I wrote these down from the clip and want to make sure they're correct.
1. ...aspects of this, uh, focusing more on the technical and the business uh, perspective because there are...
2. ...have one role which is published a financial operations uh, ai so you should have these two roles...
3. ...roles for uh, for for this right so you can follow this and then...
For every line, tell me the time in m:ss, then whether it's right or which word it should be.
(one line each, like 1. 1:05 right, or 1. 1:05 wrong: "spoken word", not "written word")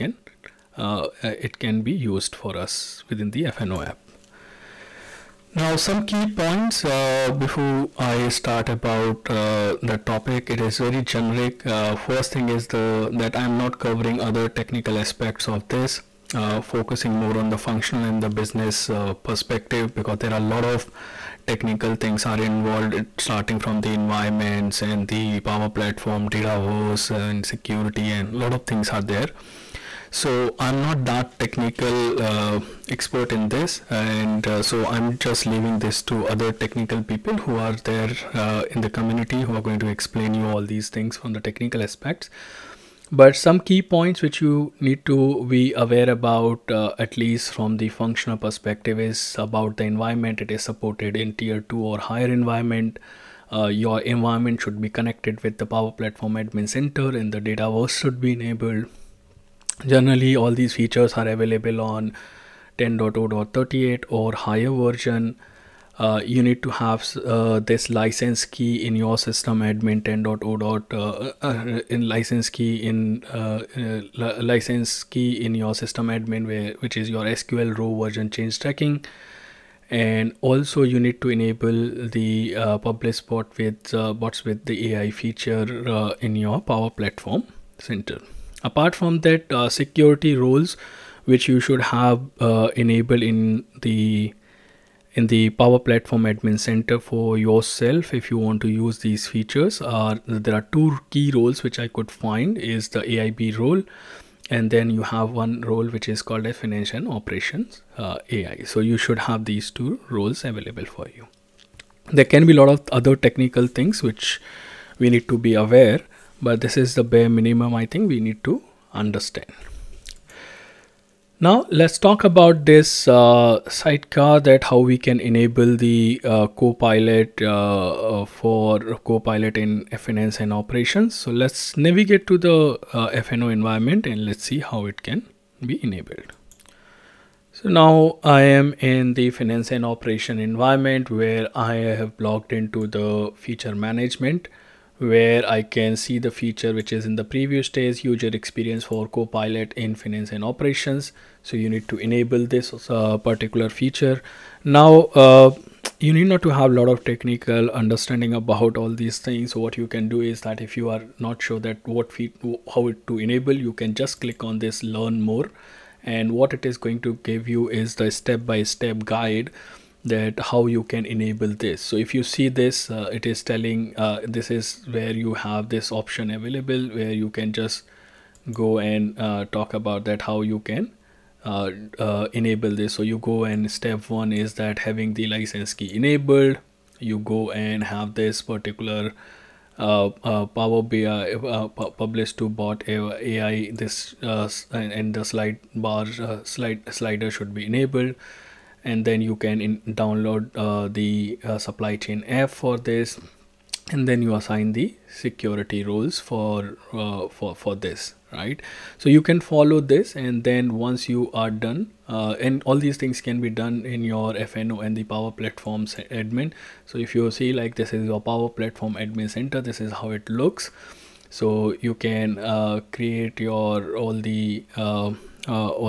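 1. 0:15 wrong: "functional", not "technical"
2. 1:45 wrong: "called", not "published"
3. 3:25 wrong: "rules", not "roles".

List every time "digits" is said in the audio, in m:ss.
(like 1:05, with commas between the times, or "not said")
not said.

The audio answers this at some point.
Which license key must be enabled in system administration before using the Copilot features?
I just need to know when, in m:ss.
1:17.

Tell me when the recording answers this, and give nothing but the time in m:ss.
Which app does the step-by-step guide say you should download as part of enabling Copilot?
3:21.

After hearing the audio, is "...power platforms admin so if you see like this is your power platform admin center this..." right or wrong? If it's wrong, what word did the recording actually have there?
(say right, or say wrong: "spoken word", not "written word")
right.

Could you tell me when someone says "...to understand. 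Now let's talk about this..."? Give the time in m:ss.
1:58.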